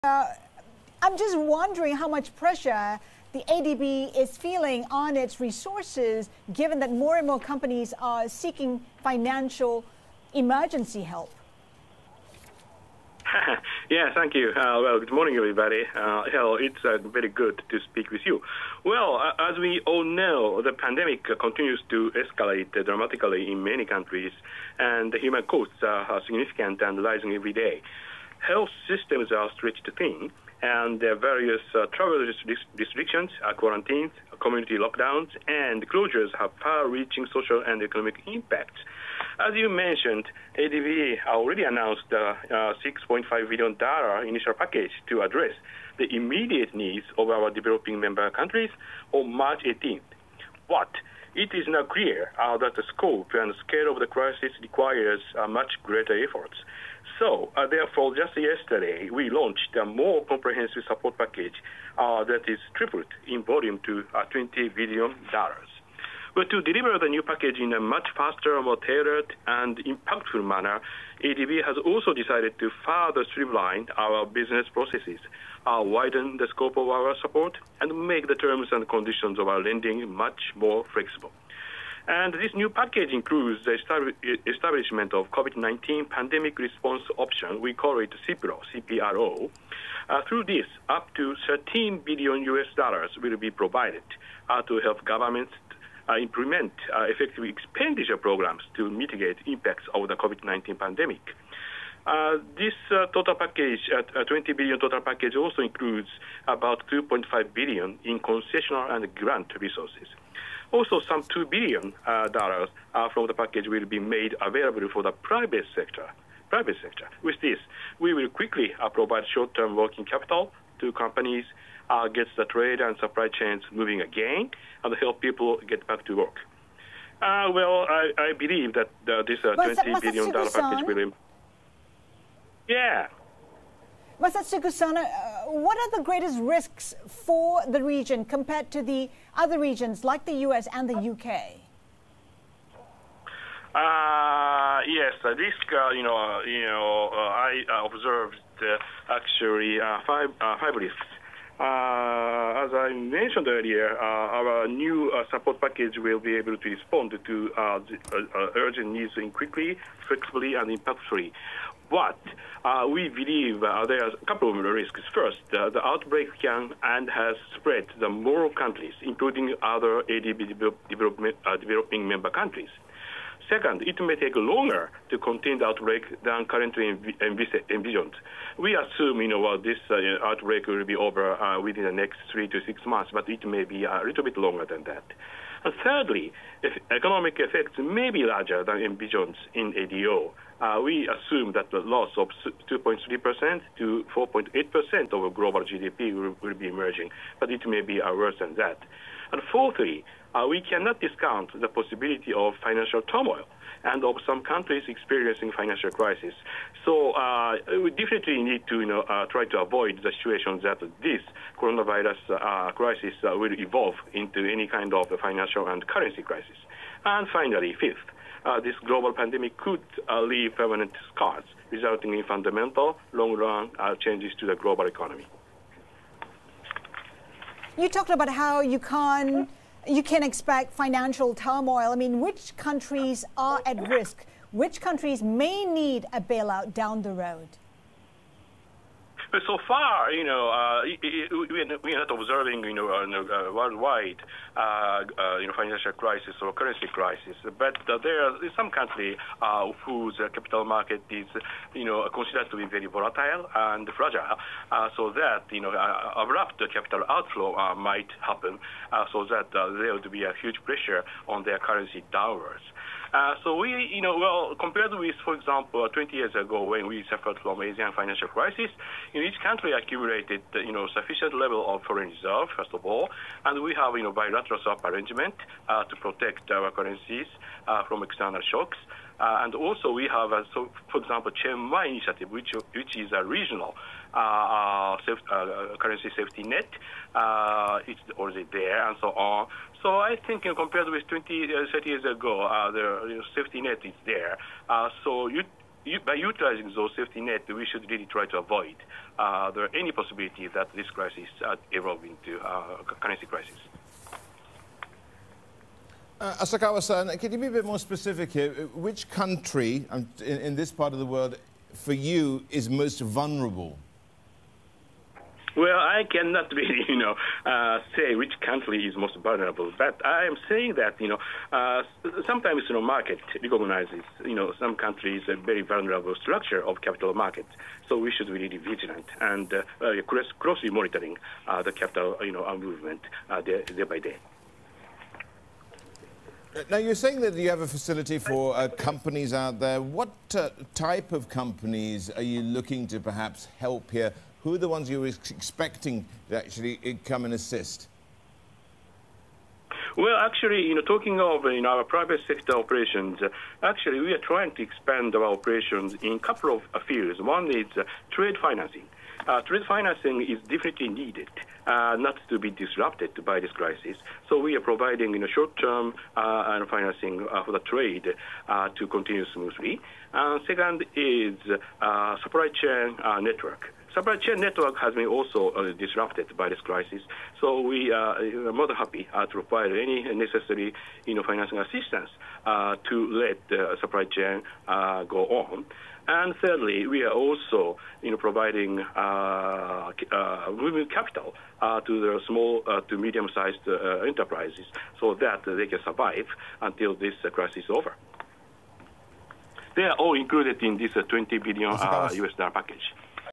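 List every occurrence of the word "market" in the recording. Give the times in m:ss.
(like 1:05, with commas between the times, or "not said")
4:10, 5:22, 5:27.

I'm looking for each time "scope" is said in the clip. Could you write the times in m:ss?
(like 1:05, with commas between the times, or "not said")
0:52, 1:16.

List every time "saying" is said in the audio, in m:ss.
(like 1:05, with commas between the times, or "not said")
5:20, 5:36.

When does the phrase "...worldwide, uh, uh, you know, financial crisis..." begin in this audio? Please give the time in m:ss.
4:03.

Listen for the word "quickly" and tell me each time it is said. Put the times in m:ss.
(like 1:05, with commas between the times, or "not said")
1:58, 2:39.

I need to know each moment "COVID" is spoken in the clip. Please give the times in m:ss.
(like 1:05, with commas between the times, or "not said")
1:25, 1:40.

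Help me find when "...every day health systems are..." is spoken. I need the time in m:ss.
0:27.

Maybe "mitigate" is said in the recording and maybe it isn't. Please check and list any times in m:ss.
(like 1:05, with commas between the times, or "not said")
1:38.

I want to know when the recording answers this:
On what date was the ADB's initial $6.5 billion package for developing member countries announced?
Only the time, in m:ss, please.
0:49.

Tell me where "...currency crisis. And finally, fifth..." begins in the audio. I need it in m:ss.
3:35.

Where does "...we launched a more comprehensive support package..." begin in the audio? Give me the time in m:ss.
0:59.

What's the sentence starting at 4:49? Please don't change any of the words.
So I think you uh, know, compared with 20, uh, 30 years ago, uh, the you know, safety net is there.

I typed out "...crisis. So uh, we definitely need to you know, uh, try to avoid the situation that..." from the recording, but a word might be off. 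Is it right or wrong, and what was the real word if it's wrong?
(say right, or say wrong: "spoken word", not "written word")
right.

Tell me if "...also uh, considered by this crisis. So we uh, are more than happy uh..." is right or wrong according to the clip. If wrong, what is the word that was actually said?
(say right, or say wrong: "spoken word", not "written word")
wrong: "disrupted", not "considered".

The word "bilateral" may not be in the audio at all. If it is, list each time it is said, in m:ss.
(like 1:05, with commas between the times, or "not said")
4:34.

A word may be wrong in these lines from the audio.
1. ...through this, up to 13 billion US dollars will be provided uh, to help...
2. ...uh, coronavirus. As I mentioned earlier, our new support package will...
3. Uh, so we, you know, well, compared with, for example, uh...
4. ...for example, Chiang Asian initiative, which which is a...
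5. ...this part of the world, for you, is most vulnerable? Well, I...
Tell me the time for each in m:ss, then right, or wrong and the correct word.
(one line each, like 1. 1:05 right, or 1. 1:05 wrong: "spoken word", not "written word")
1. 1:30 right
2. 2:30 wrong: "fibrous", not "coronavirus"
3. 4:23 right
4. 4:40 wrong: "Mai", not "Asian"
5. 5:10 right.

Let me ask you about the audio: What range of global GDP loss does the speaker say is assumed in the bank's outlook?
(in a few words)
2.3% to 4.8%.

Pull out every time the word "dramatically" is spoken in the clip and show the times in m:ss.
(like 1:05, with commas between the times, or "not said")
0:22.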